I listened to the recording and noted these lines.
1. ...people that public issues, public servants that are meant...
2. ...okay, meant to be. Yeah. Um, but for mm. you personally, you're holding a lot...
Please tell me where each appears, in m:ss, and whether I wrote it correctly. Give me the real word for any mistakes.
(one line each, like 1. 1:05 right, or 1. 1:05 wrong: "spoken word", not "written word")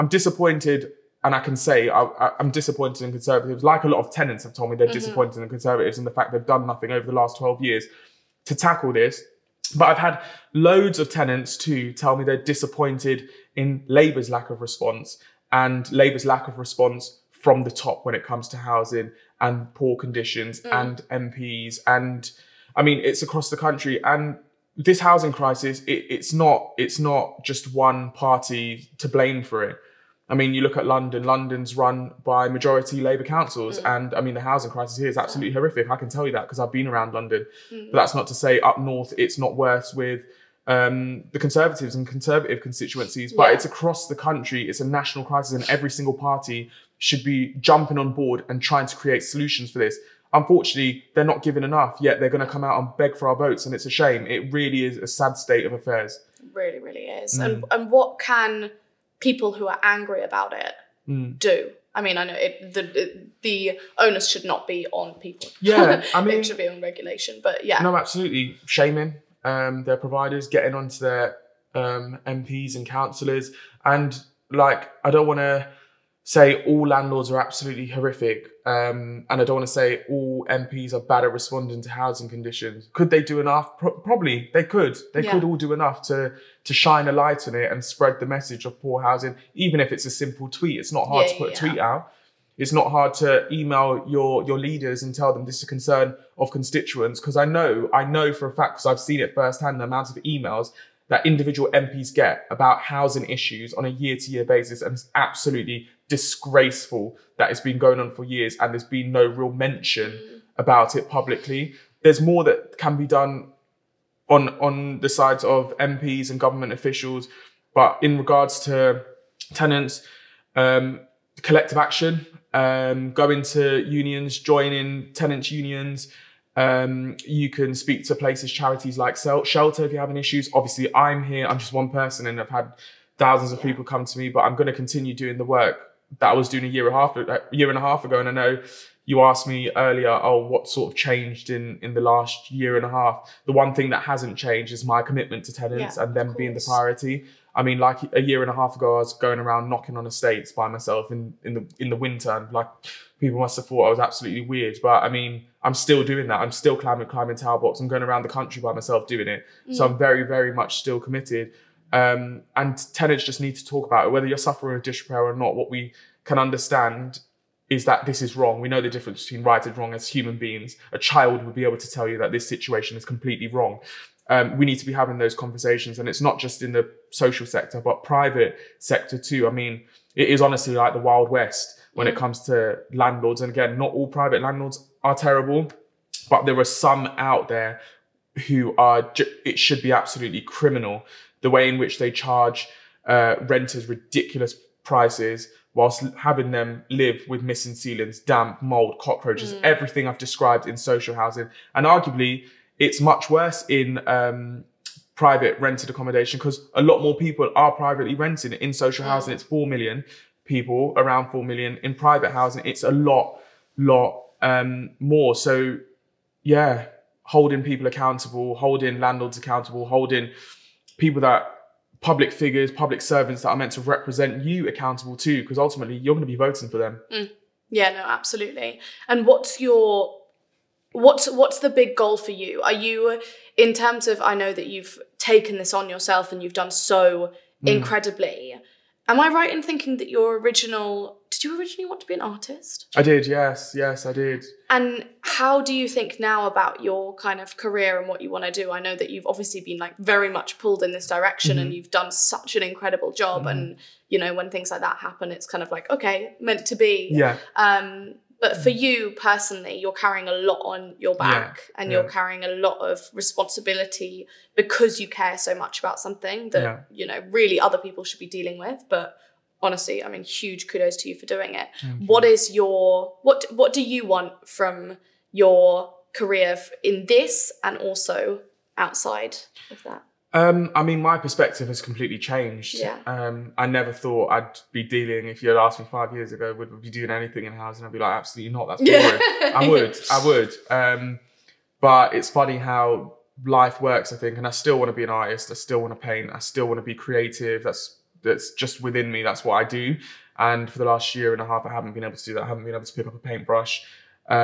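1. 3:40 wrong: "figures", not "issues"
2. 4:15 wrong: "carrying", not "holding".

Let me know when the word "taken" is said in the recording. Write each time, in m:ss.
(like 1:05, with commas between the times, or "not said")
3:55.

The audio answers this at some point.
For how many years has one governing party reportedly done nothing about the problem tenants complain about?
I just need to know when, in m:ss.
0:07.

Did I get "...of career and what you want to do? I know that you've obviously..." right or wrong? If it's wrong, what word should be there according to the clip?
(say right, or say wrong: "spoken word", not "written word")
right.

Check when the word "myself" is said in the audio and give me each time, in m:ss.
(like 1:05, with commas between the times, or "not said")
2:30, 2:38.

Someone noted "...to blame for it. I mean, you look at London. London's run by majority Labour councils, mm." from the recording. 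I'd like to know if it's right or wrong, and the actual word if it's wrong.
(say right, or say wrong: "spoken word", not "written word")
right.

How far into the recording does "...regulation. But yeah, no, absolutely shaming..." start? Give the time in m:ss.
1:06.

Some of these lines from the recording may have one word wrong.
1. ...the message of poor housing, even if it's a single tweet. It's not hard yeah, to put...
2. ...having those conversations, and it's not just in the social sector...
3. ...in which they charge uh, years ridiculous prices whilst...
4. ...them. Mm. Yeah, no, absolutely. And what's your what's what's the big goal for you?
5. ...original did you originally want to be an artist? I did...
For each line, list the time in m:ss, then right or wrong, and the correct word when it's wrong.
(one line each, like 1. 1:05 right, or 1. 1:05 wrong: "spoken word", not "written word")
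1. 1:28 wrong: "simple", not "single"
2. 2:54 right
3. 3:11 wrong: "renters", not "years"
4. 3:46 right
5. 4:00 right.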